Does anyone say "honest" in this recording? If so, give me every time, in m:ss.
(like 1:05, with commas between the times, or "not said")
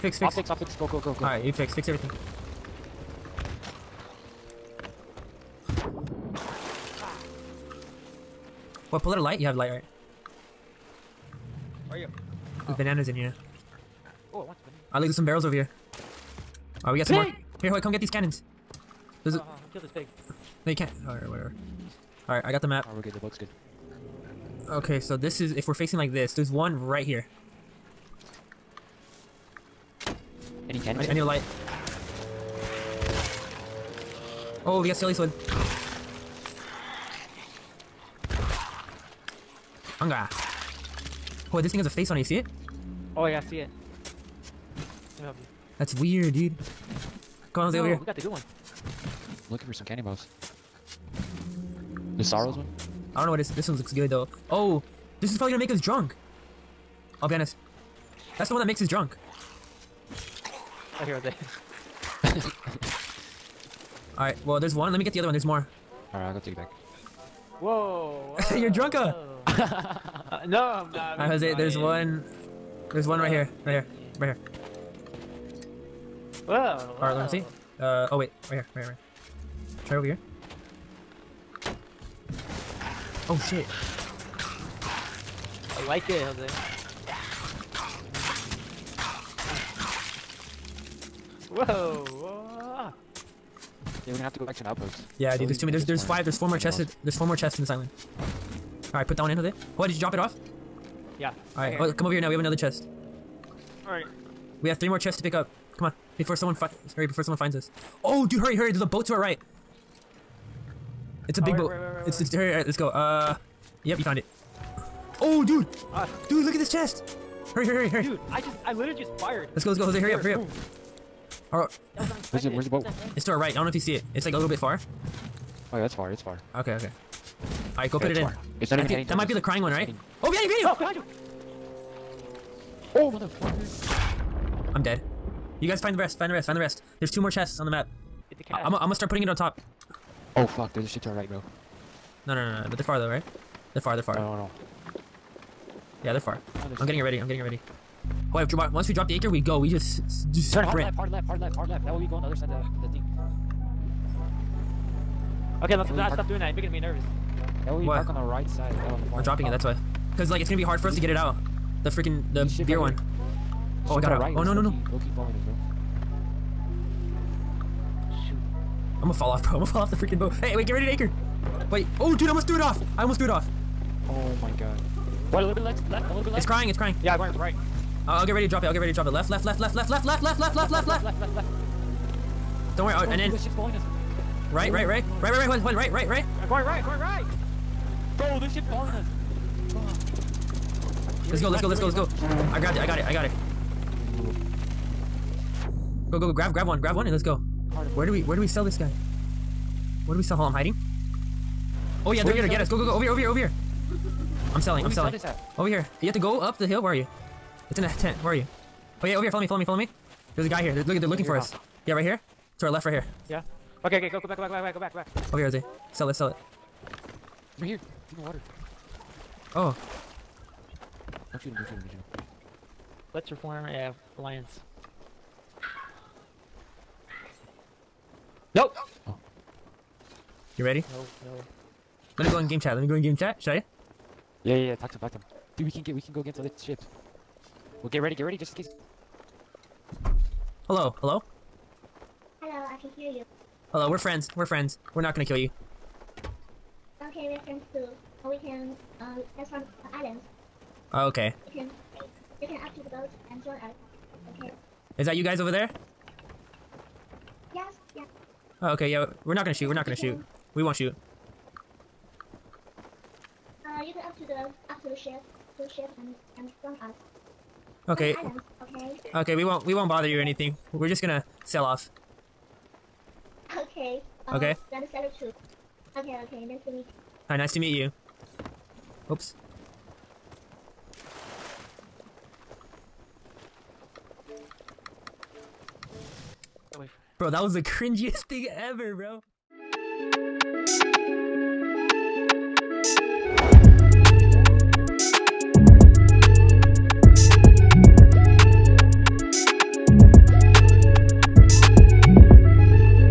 0:57.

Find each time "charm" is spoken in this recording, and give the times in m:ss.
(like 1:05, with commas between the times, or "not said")
not said.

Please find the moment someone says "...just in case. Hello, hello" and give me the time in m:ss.
3:58.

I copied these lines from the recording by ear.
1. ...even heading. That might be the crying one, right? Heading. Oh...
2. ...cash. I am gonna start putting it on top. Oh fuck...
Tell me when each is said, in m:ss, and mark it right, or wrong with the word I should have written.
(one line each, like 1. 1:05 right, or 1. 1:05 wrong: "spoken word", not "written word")
1. 2:08 right
2. 2:18 right.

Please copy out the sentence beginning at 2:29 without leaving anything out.
We just, just Turn hard left, hard left, hard left, hard left.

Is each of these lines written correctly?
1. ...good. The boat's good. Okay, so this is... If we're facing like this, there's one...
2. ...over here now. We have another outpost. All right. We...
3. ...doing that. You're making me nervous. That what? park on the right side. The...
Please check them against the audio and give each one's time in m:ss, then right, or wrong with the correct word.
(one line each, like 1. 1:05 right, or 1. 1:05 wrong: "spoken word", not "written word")
1. 0:23 right
2. 1:42 wrong: "chest", not "outpost"
3. 2:36 right.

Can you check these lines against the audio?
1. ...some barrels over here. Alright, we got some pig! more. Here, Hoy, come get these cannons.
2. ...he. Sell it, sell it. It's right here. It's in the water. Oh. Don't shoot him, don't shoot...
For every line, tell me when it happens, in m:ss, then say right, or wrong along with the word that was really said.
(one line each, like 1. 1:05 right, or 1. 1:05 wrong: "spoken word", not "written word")
1. 0:15 right
2. 3:35 right.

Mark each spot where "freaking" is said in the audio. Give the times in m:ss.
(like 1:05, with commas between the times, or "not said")
2:41, 2:49.